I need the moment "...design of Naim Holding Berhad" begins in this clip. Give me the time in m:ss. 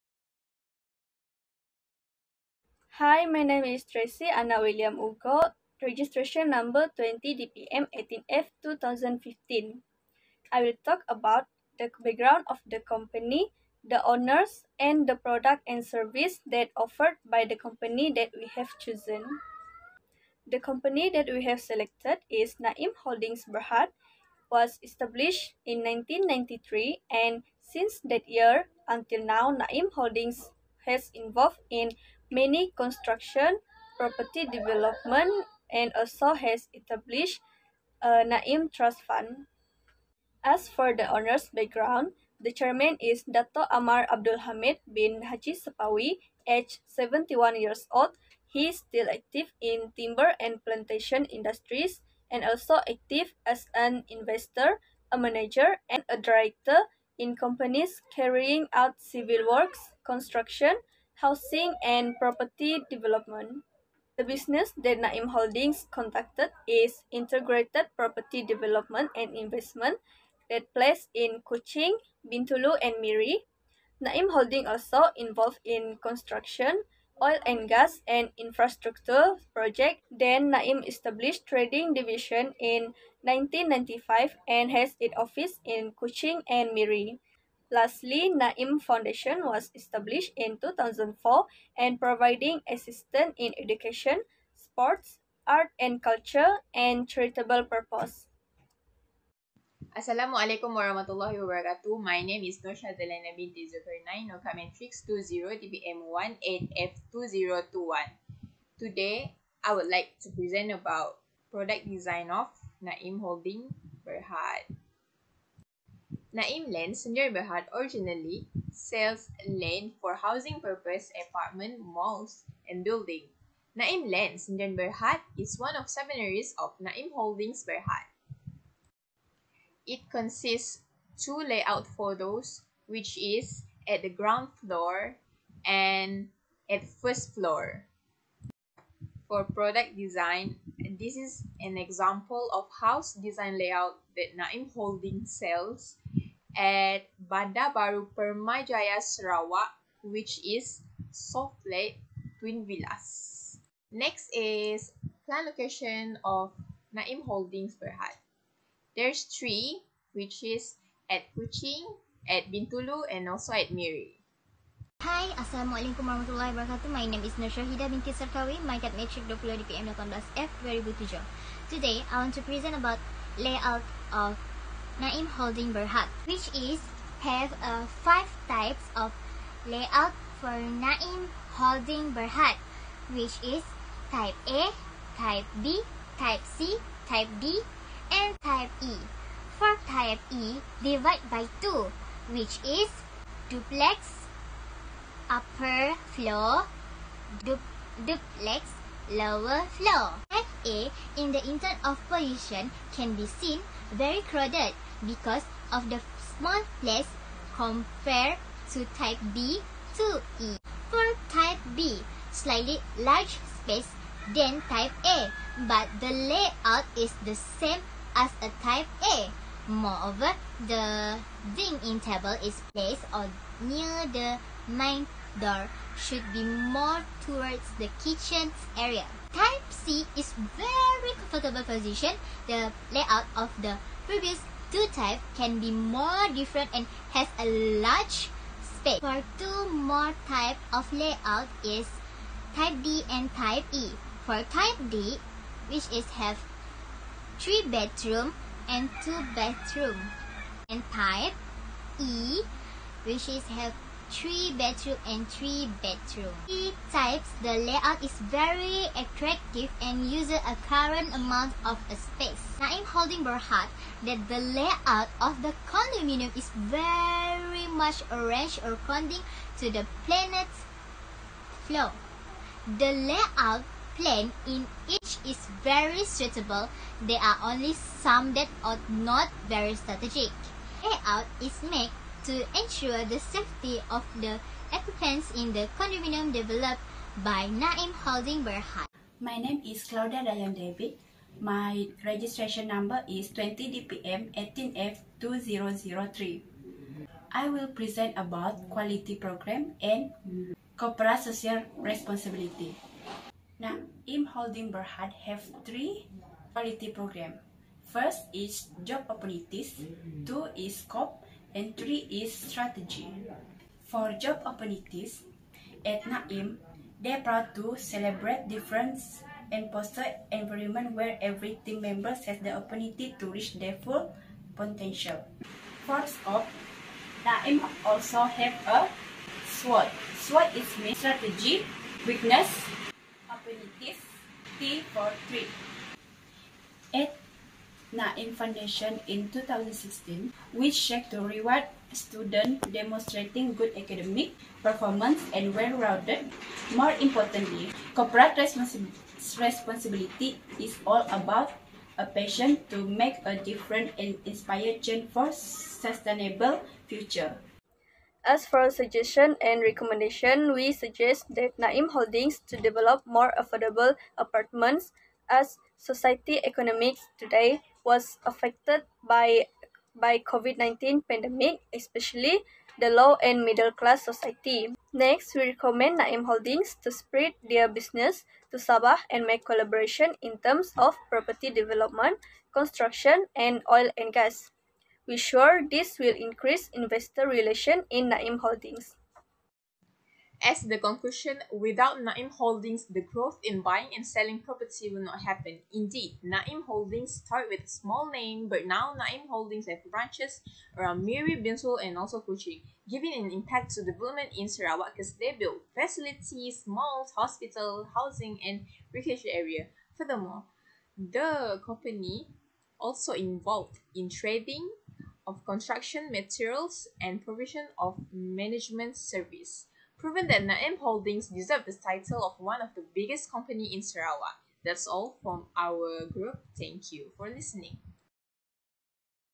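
1:51.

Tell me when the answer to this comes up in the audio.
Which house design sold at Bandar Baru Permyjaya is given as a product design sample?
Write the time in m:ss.
2:31.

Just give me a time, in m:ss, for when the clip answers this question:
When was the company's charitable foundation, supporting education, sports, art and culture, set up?
1:30.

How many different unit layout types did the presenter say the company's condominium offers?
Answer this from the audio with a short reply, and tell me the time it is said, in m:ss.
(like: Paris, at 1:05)
5, at 2:58.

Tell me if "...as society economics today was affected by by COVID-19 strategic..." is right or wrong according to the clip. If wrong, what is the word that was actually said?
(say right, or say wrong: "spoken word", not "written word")
wrong: "pandemic", not "strategic".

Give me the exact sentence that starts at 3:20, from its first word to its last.
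A in the intern of position can be seen very crowded because of the small place compared to type B to E.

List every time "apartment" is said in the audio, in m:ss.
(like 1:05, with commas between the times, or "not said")
2:01, 6:04.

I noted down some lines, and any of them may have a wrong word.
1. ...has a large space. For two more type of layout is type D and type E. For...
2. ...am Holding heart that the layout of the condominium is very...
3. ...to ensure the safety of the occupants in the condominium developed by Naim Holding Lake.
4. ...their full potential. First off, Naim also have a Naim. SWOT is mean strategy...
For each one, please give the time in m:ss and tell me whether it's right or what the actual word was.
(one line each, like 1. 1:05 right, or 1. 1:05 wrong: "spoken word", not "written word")
1. 3:57 right
2. 4:22 right
3. 4:42 wrong: "Berhad", not "Lake"
4. 5:23 wrong: "SWOT", not "Naim".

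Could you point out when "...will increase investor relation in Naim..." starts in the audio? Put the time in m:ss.
6:25.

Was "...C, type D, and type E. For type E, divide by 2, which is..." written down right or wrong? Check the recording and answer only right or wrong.
right.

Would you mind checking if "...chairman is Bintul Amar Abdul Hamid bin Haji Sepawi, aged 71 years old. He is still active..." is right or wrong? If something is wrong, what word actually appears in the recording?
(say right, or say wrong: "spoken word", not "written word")
wrong: "Dato", not "Bintul".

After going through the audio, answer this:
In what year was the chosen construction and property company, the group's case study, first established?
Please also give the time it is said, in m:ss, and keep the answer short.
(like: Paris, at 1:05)
1993, at 0:25.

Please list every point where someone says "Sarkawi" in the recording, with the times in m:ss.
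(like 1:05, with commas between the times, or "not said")
2:48.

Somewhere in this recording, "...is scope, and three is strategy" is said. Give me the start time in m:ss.
5:10.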